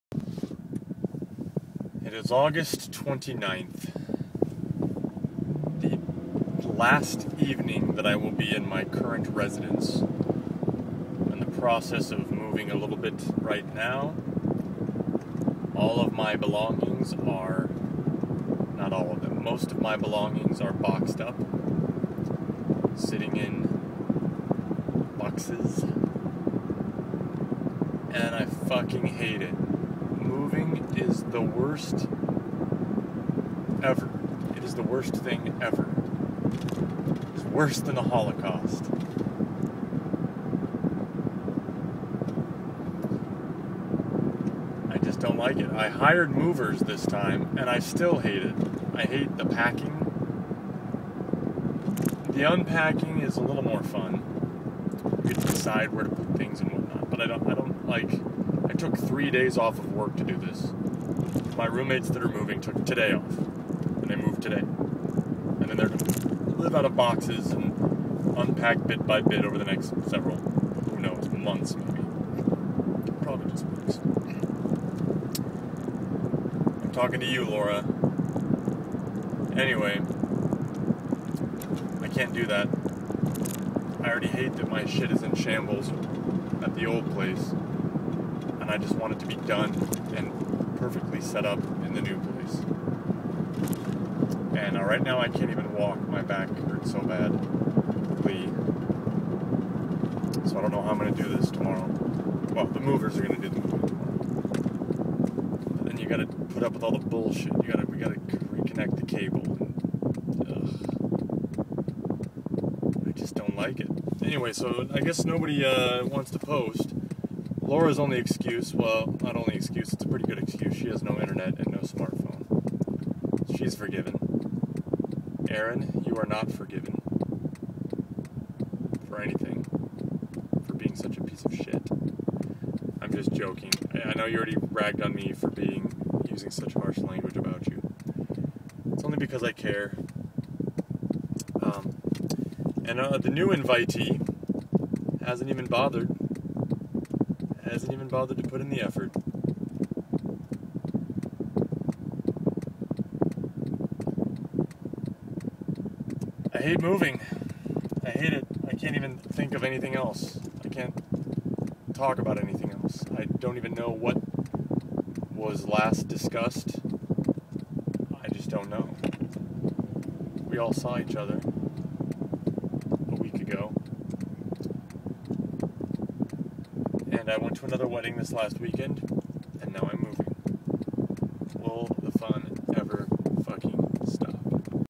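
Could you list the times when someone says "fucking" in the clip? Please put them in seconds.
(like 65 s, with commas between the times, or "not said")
28 s.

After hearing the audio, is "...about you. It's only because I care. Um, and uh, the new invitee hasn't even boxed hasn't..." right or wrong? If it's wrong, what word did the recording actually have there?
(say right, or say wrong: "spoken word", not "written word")
wrong: "bothered", not "boxed".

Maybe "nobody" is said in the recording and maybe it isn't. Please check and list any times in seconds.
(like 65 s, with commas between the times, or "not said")
115 s.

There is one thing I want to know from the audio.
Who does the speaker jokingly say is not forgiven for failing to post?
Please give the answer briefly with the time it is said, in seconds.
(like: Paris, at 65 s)
Aaron, at 125 s.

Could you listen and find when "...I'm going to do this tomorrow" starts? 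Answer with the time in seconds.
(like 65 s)
100 s.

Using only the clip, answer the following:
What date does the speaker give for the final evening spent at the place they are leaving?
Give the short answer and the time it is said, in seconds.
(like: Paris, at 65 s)
August 29, at 2 s.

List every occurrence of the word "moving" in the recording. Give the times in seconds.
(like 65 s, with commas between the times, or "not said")
12 s, 30 s, 62 s, 103 s, 156 s.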